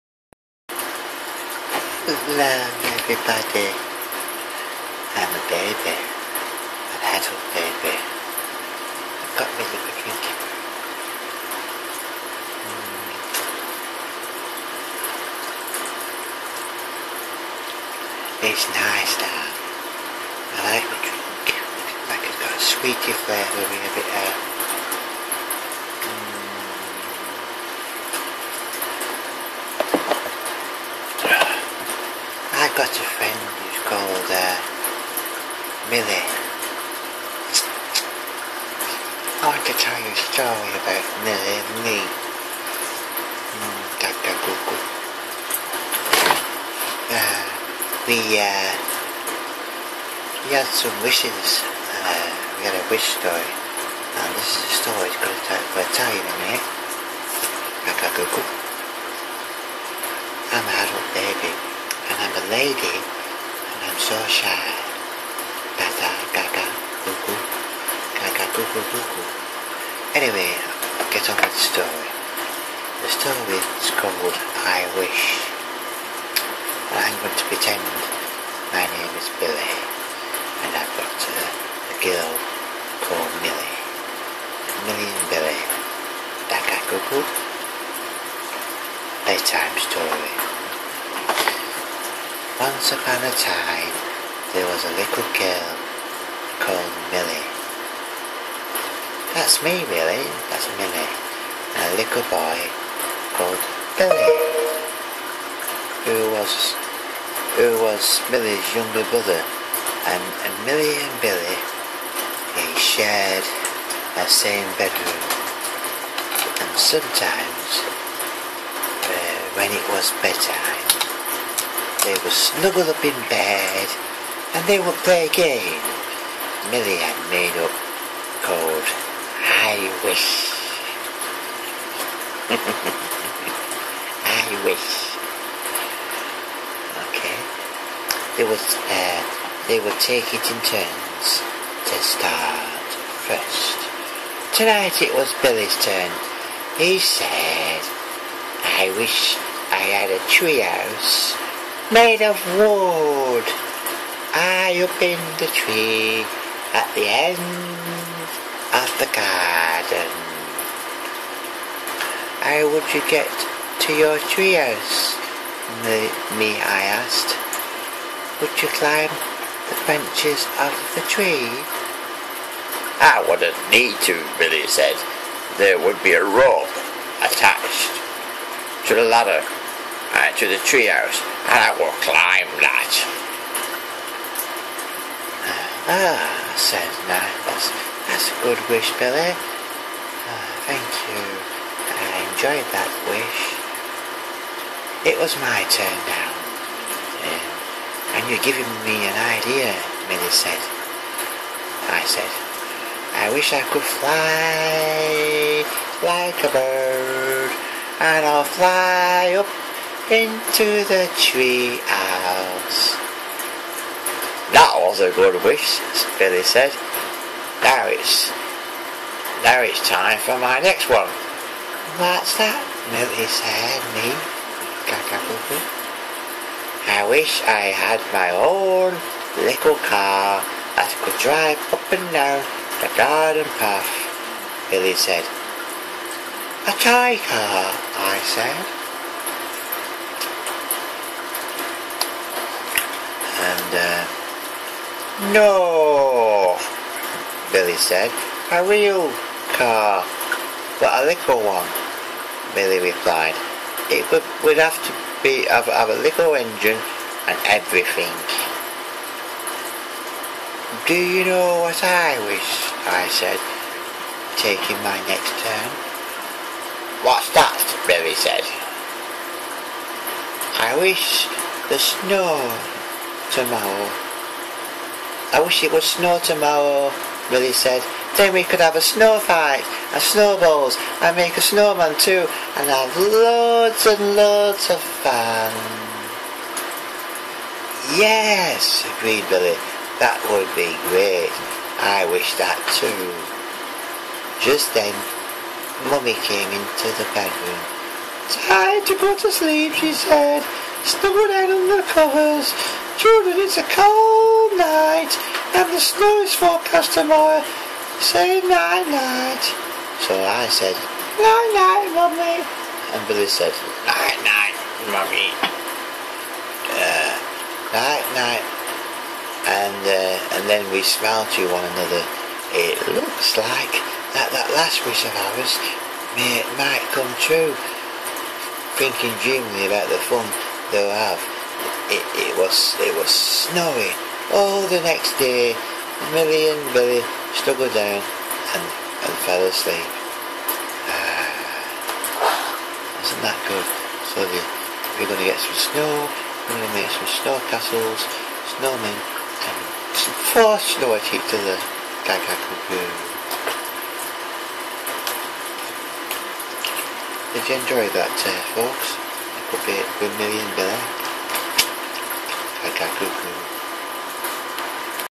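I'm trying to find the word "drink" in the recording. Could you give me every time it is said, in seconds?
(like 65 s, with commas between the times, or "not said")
10 s, 21 s.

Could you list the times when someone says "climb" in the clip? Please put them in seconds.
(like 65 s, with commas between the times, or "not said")
168 s, 181 s.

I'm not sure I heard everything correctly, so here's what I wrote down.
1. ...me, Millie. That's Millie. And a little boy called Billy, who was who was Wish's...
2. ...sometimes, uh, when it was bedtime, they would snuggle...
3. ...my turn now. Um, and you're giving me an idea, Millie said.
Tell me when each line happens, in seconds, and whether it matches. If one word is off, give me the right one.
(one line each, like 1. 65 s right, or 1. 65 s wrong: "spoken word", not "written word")
1. 99 s wrong: "Millie", not "Wish"
2. 116 s right
3. 195 s wrong: "Minnie", not "Millie".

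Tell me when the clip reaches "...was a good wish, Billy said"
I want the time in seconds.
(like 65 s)
214 s.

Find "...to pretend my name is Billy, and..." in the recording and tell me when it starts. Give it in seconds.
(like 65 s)
77 s.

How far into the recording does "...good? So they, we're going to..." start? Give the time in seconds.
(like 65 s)
343 s.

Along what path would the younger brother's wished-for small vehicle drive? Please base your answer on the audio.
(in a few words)
garden path.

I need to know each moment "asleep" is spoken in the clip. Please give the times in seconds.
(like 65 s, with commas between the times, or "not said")
339 s.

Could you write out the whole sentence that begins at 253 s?
It would, would have to be have, have a little engine and everything.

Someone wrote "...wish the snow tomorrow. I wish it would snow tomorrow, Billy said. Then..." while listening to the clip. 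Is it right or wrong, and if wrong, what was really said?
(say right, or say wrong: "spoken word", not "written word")
right.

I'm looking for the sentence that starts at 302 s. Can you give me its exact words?
Children, it's a cold night, and the snow is forecast tomorrow.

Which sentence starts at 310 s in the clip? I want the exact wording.
So I said, night, night, mummy.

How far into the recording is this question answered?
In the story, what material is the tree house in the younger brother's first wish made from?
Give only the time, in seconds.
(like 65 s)
151 s.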